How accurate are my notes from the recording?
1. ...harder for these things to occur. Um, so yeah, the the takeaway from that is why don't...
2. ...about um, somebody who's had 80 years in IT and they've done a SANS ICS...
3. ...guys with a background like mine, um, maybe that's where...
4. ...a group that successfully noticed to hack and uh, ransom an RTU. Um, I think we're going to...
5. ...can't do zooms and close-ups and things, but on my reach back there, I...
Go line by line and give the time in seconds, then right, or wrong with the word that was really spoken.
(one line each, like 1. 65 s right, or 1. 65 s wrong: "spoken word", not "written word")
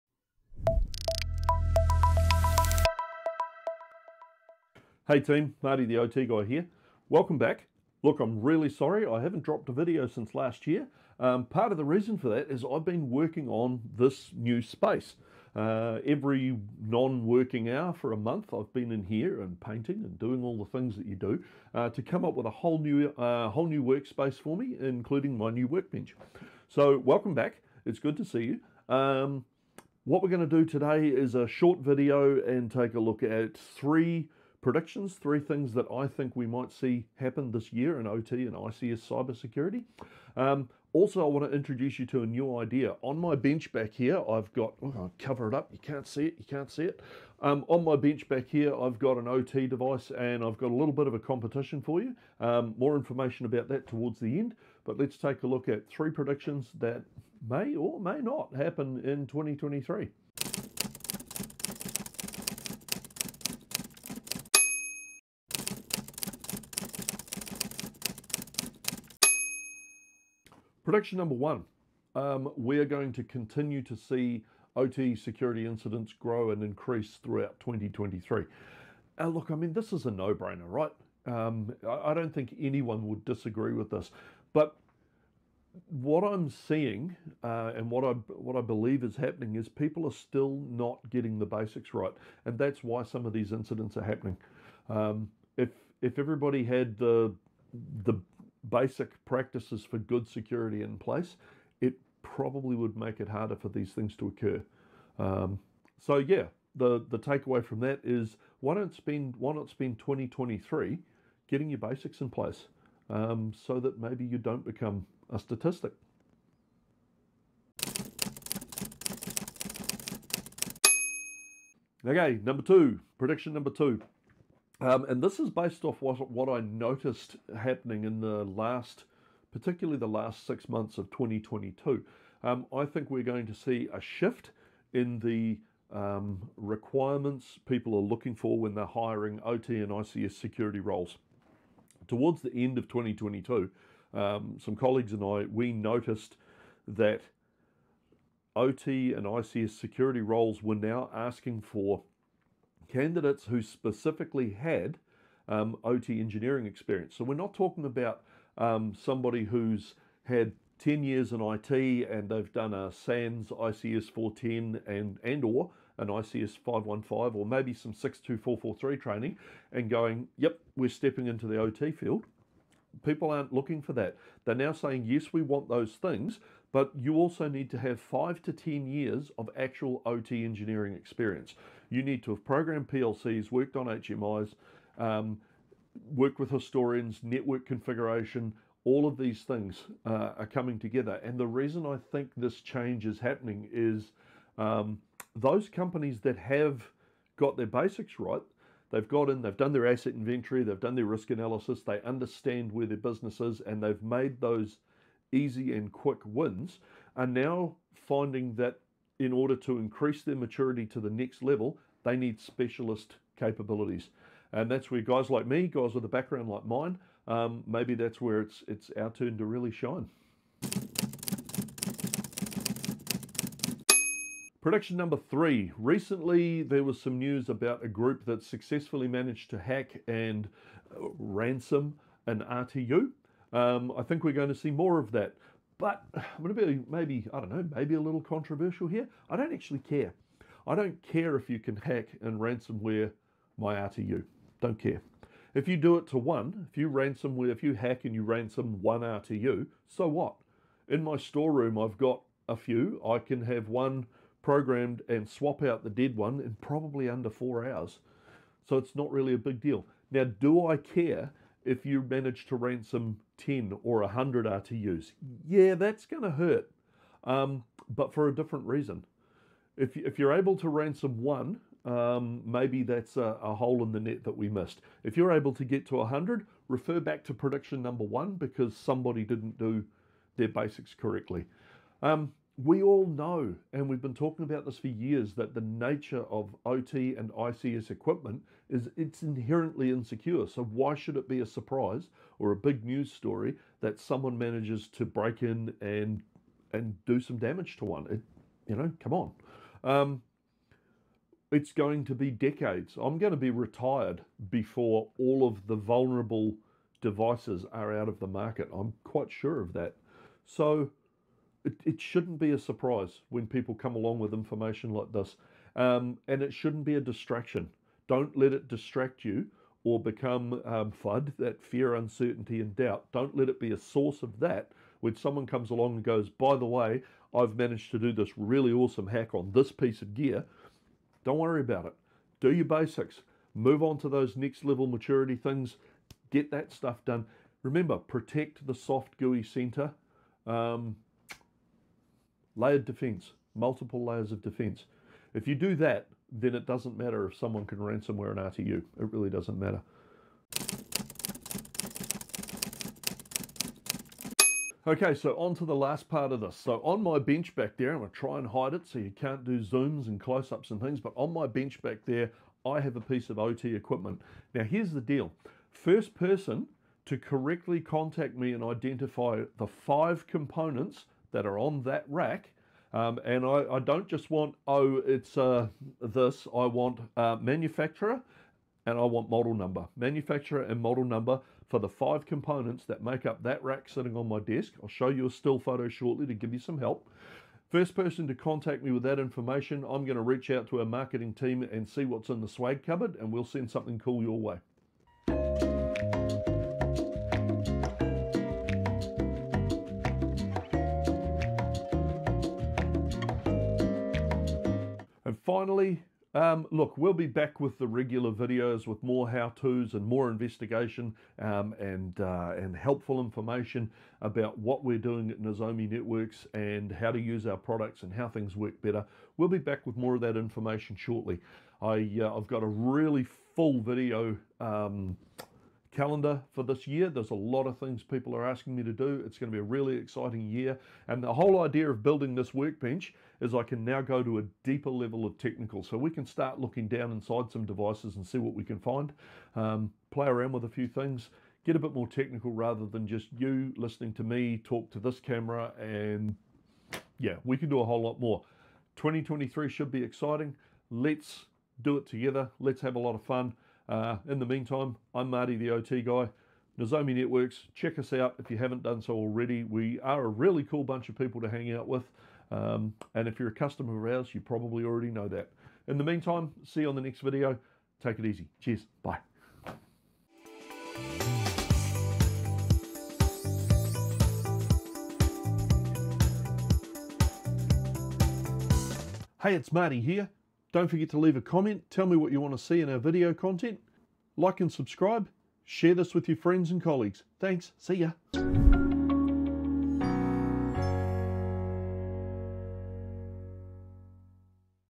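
1. 103 s right
2. 157 s wrong: "10", not "80"
3. 215 s right
4. 227 s wrong: "managed", not "noticed"
5. 359 s wrong: "bench", not "reach".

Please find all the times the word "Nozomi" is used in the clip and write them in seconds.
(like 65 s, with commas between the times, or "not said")
415 s, 456 s.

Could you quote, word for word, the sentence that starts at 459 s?
We are a really cool bunch of people to hang out with.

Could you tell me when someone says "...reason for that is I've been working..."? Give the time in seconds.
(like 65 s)
11 s.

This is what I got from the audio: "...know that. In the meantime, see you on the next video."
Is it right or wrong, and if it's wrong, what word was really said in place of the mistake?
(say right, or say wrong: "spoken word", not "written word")
right.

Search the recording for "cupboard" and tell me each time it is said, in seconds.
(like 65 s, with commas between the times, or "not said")
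392 s.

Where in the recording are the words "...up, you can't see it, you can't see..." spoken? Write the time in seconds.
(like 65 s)
45 s.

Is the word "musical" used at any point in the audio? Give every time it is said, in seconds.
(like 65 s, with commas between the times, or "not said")
not said.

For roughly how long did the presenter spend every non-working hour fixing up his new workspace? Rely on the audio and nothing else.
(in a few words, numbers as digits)
A month.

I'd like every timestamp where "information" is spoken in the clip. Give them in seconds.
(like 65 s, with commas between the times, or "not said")
52 s, 314 s, 389 s, 413 s, 420 s.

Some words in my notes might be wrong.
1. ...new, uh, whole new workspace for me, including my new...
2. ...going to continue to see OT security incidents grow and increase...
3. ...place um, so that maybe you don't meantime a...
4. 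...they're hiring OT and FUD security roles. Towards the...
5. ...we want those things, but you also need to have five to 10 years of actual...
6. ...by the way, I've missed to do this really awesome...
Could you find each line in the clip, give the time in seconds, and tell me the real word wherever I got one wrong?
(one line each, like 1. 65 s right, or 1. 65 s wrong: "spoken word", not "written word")
1. 22 s right
2. 72 s right
3. 112 s wrong: "become", not "meantime"
4. 138 s wrong: "ICS", not "FUD"
5. 175 s right
6. 326 s wrong: "managed", not "missed".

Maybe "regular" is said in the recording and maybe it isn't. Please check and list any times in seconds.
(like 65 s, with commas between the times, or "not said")
407 s.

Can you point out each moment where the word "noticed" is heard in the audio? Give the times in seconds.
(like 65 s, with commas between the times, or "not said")
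126 s, 145 s.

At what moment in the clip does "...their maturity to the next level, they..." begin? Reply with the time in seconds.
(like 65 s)
210 s.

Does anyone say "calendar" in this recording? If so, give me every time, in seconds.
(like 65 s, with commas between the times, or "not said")
425 s.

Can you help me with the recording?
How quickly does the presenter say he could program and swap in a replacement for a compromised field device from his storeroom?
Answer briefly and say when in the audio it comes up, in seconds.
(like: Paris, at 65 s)
Under four hours, at 257 s.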